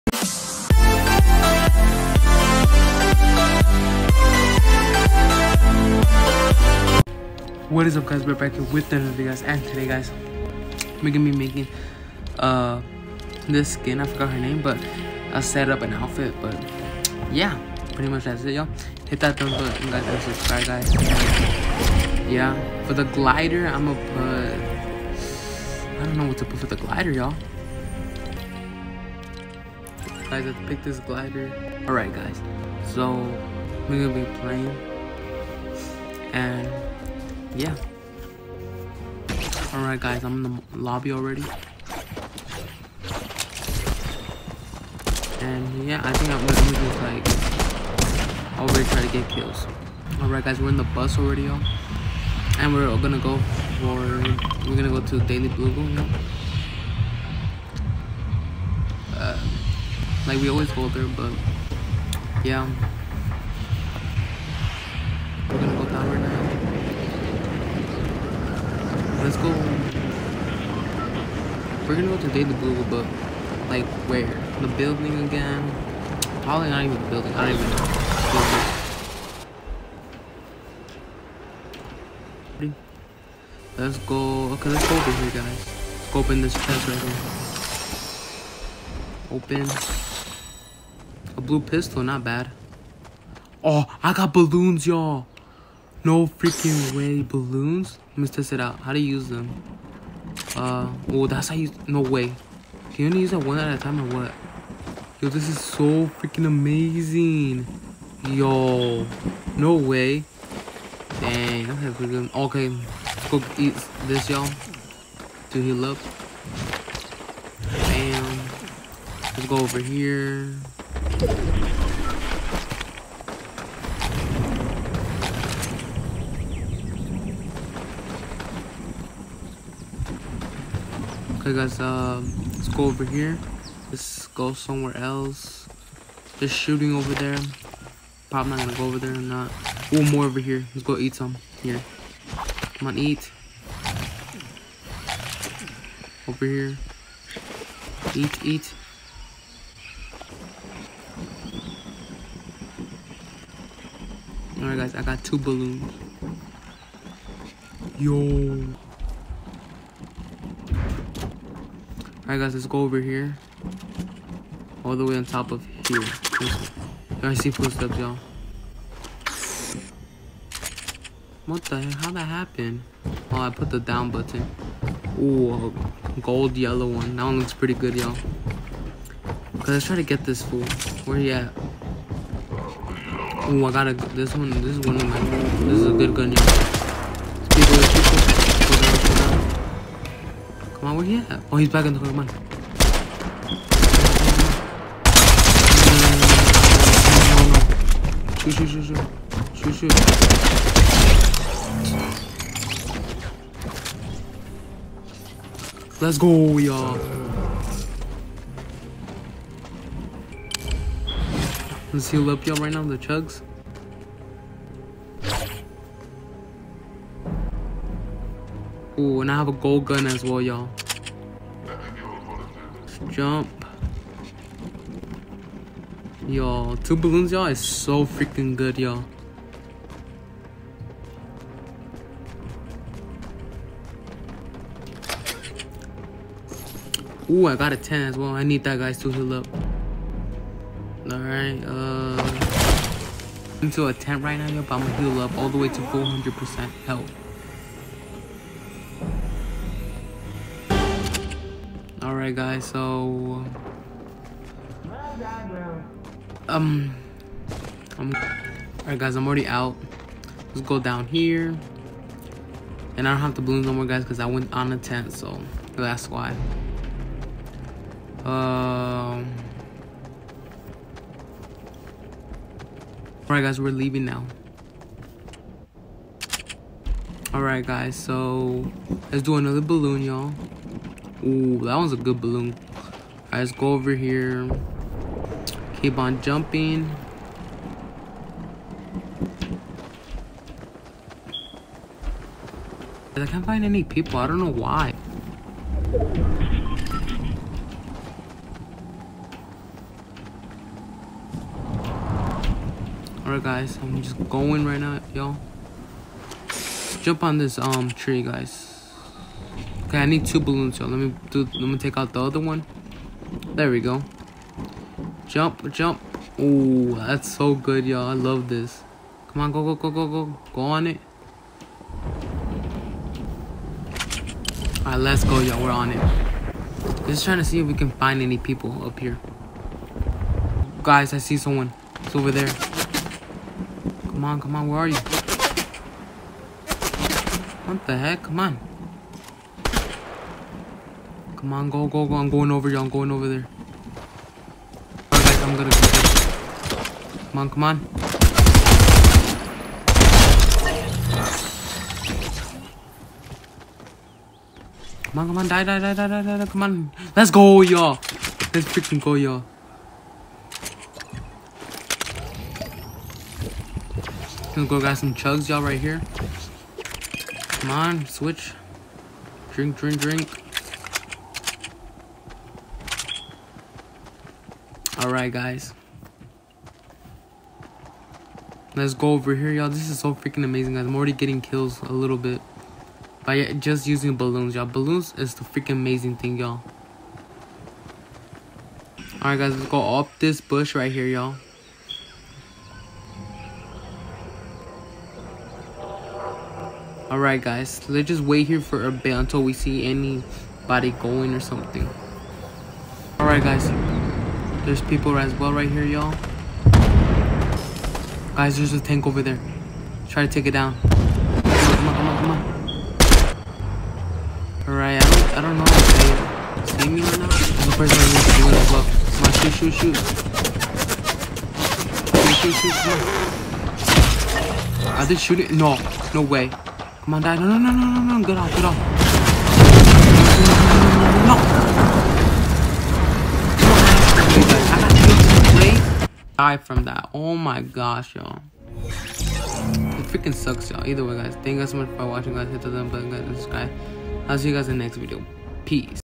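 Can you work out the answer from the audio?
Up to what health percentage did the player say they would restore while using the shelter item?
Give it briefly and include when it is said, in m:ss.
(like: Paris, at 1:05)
400%, at 4:05.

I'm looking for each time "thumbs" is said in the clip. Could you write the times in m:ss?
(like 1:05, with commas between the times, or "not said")
0:19.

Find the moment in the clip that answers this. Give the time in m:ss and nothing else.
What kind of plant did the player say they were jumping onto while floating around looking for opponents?
5:07.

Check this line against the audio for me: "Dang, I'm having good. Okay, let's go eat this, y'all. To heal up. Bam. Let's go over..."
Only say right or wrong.
right.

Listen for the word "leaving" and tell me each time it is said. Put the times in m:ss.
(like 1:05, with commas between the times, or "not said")
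4:33.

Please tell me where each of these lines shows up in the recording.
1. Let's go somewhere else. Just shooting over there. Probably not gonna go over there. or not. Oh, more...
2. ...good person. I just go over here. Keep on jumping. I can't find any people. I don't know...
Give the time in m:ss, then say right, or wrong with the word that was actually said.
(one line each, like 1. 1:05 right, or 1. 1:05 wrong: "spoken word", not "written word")
1. 2:13 right
2. 4:41 wrong: "balloon", not "person".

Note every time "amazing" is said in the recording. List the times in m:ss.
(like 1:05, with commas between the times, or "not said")
1:46, 6:20, 6:25.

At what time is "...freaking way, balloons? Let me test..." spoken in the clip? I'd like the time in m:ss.
1:36.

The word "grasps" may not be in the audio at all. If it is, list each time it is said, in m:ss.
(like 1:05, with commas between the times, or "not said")
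not said.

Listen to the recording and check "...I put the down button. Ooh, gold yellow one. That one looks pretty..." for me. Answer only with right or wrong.
right.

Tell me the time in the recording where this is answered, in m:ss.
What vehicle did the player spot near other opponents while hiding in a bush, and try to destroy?
6:48.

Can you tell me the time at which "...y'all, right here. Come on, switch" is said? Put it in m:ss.
6:05.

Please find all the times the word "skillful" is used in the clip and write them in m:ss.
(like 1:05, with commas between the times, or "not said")
not said.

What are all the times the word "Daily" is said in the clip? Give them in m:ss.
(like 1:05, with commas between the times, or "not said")
0:55, 1:12.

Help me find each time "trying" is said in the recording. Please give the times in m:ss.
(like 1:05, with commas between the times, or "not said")
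5:27.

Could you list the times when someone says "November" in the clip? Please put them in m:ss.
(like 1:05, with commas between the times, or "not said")
not said.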